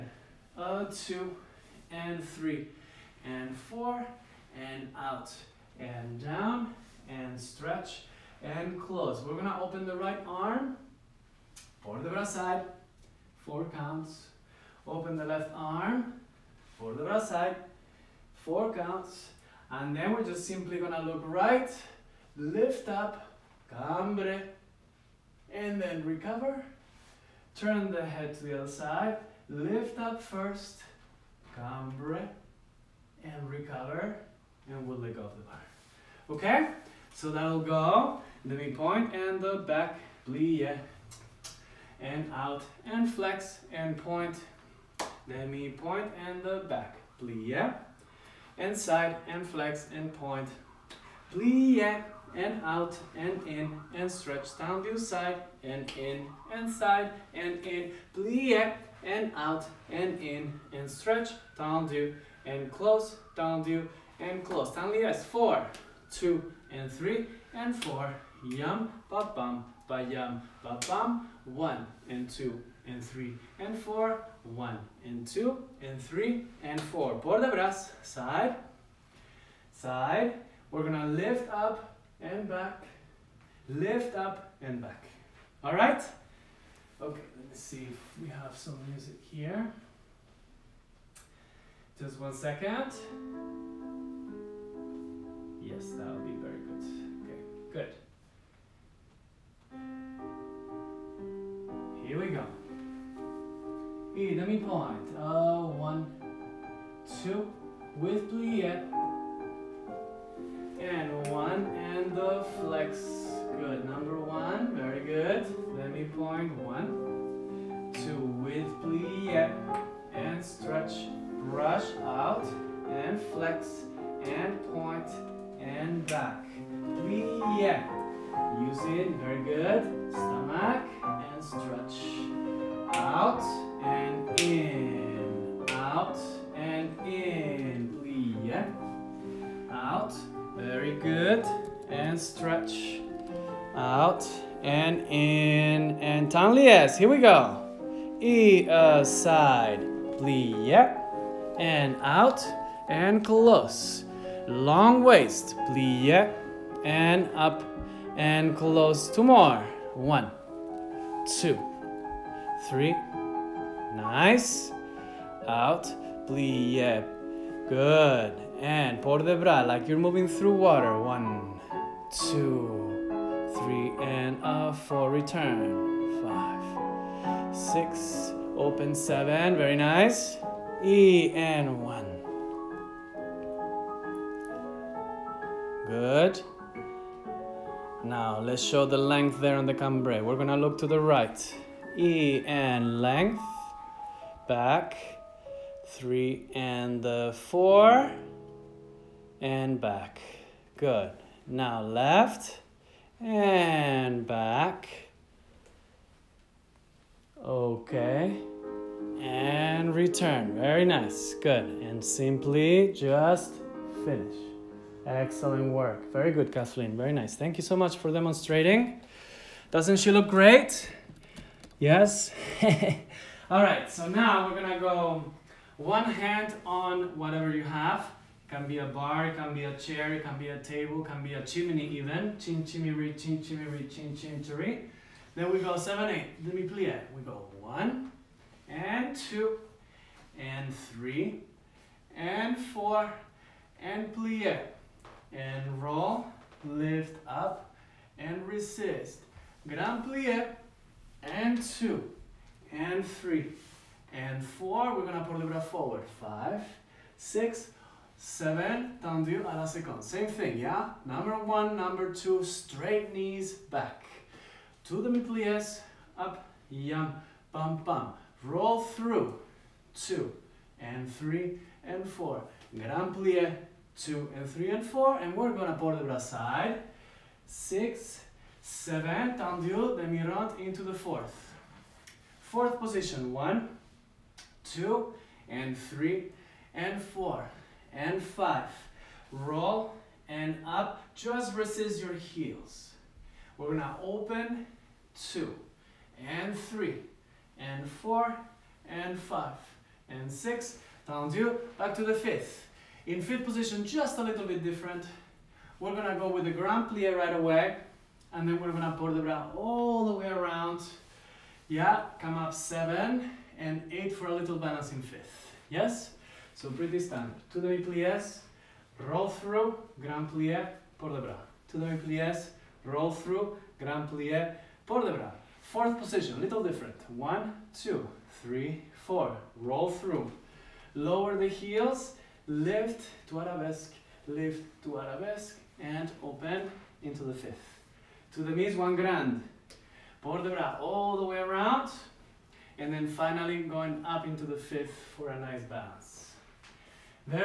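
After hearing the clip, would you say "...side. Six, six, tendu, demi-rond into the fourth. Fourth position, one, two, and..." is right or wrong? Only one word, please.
wrong.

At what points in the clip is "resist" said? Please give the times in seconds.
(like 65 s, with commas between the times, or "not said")
248 s, 291 s.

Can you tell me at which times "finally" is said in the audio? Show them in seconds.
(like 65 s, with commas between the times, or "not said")
343 s.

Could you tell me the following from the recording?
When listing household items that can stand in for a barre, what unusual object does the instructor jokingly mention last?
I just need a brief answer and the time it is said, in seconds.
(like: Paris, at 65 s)
a chimney, at 231 s.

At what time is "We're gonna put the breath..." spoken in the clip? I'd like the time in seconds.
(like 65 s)
254 s.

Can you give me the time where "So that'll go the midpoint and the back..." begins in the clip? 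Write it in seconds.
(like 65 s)
37 s.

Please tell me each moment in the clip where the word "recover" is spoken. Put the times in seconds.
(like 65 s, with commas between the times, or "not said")
26 s, 33 s.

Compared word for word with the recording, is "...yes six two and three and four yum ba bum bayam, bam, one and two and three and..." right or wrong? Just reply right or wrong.
wrong.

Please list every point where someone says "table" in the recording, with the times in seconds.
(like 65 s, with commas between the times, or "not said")
230 s.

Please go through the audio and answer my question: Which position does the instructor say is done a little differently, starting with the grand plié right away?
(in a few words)
fifth position.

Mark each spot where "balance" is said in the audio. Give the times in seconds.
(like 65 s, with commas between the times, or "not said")
314 s, 345 s.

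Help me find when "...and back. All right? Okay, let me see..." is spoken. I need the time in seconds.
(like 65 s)
84 s.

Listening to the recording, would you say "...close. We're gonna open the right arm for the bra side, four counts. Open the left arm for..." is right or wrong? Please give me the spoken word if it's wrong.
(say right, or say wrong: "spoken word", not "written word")
right.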